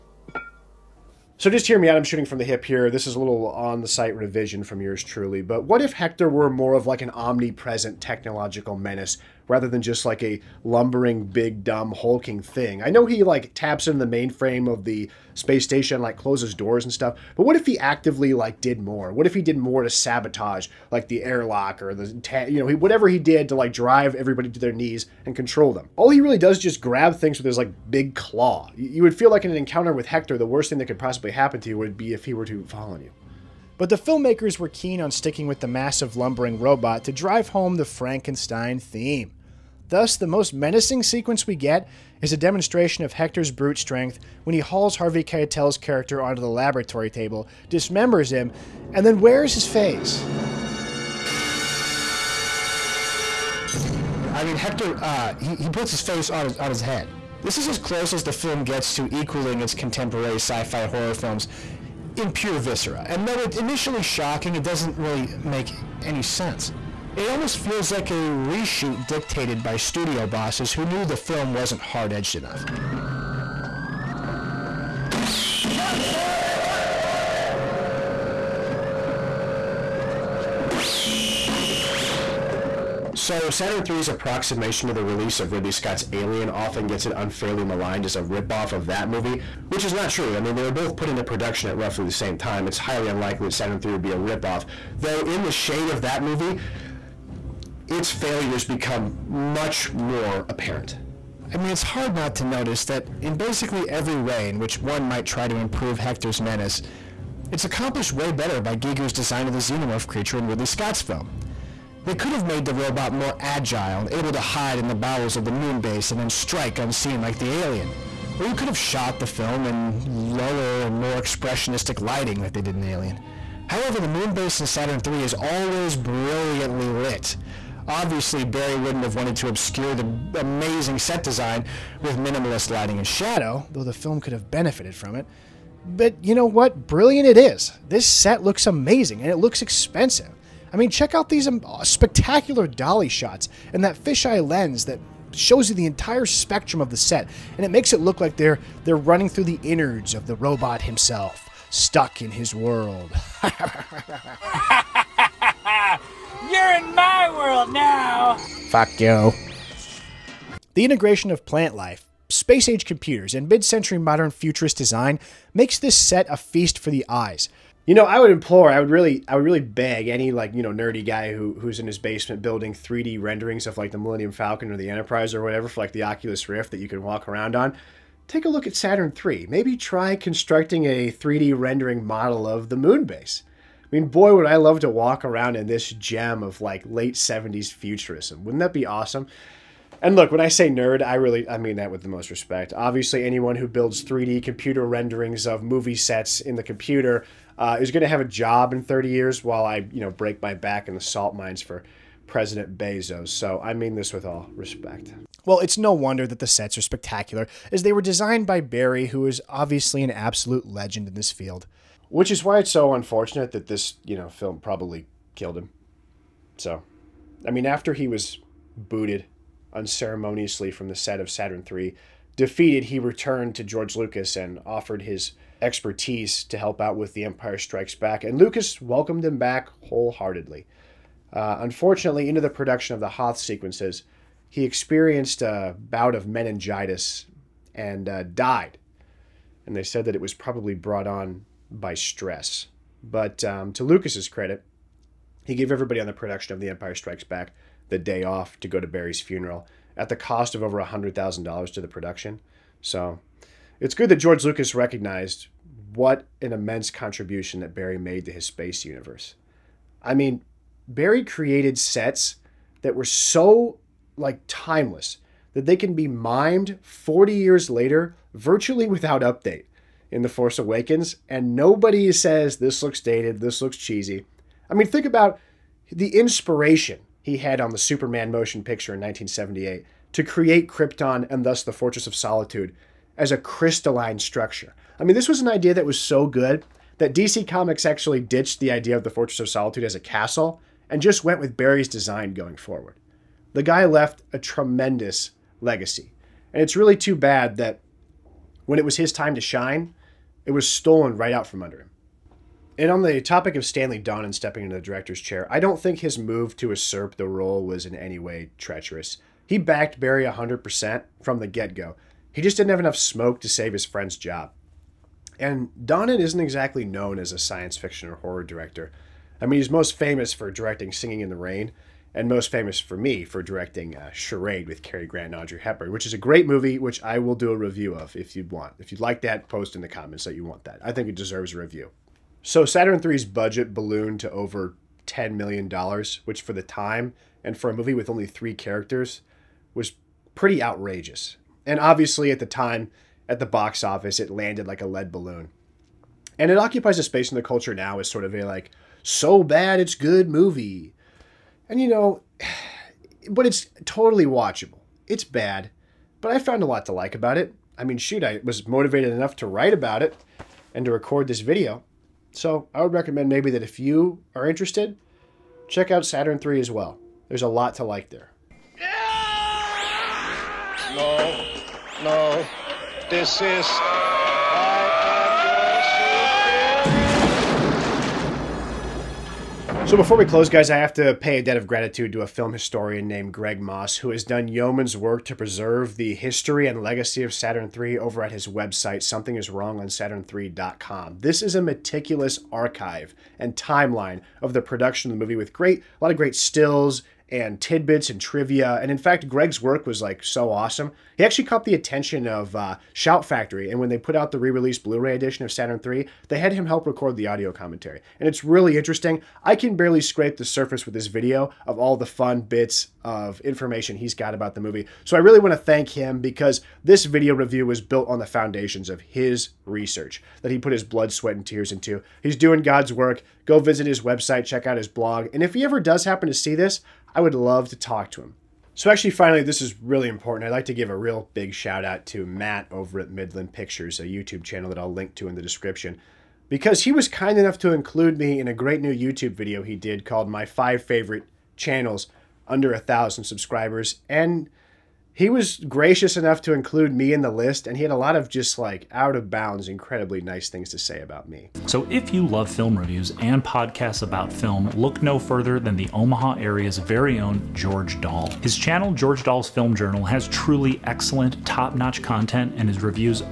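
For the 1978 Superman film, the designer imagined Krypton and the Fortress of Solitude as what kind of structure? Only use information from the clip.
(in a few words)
crystalline structure.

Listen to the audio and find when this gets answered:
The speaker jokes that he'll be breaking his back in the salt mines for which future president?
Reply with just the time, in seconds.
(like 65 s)
202 s.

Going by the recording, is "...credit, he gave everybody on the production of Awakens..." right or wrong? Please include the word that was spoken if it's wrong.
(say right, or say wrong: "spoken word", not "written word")
wrong: "The", not "Awakens".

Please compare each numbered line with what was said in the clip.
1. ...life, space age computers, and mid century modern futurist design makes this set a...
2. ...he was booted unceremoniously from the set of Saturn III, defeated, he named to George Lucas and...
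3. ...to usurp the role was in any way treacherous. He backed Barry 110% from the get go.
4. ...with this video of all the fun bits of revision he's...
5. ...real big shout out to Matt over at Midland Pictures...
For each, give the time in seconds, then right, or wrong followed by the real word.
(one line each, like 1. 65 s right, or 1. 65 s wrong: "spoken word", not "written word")
1. 161 s right
2. 217 s wrong: "returned", not "named"
3. 306 s wrong: "100", not "110"
4. 410 s wrong: "information", not "revision"
5. 430 s right.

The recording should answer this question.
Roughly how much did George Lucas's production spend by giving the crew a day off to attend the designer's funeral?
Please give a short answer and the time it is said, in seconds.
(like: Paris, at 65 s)
over $100,000, at 250 s.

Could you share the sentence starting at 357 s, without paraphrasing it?
I mean, shoot, I was motivated enough to write about it and to record this video.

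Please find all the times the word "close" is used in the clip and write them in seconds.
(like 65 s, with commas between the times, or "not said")
16 s, 57 s, 380 s.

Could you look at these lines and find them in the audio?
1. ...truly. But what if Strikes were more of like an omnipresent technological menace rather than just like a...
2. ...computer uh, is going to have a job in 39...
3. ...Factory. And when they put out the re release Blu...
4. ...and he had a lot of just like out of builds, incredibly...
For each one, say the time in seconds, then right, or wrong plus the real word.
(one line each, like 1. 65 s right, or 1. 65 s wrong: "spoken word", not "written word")
1. 5 s wrong: "Hector", not "Strikes"
2. 196 s wrong: "30", not "39"
3. 403 s right
4. 447 s wrong: "bounds", not "builds".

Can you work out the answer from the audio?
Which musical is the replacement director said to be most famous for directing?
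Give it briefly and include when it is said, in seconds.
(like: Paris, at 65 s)
Singing in the Rain, at 320 s.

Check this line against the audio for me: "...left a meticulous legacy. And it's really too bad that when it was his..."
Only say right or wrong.
wrong.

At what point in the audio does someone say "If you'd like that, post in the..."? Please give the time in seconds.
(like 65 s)
328 s.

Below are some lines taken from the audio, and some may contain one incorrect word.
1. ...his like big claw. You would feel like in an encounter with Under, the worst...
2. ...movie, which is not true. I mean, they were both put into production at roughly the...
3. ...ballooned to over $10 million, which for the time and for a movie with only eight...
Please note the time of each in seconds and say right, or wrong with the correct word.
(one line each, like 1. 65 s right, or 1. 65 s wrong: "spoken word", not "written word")
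1. 27 s wrong: "Hector", not "Under"
2. 89 s right
3. 333 s wrong: "three", not "eight".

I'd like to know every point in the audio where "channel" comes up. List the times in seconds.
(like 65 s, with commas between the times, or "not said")
434 s, 441 s, 458 s.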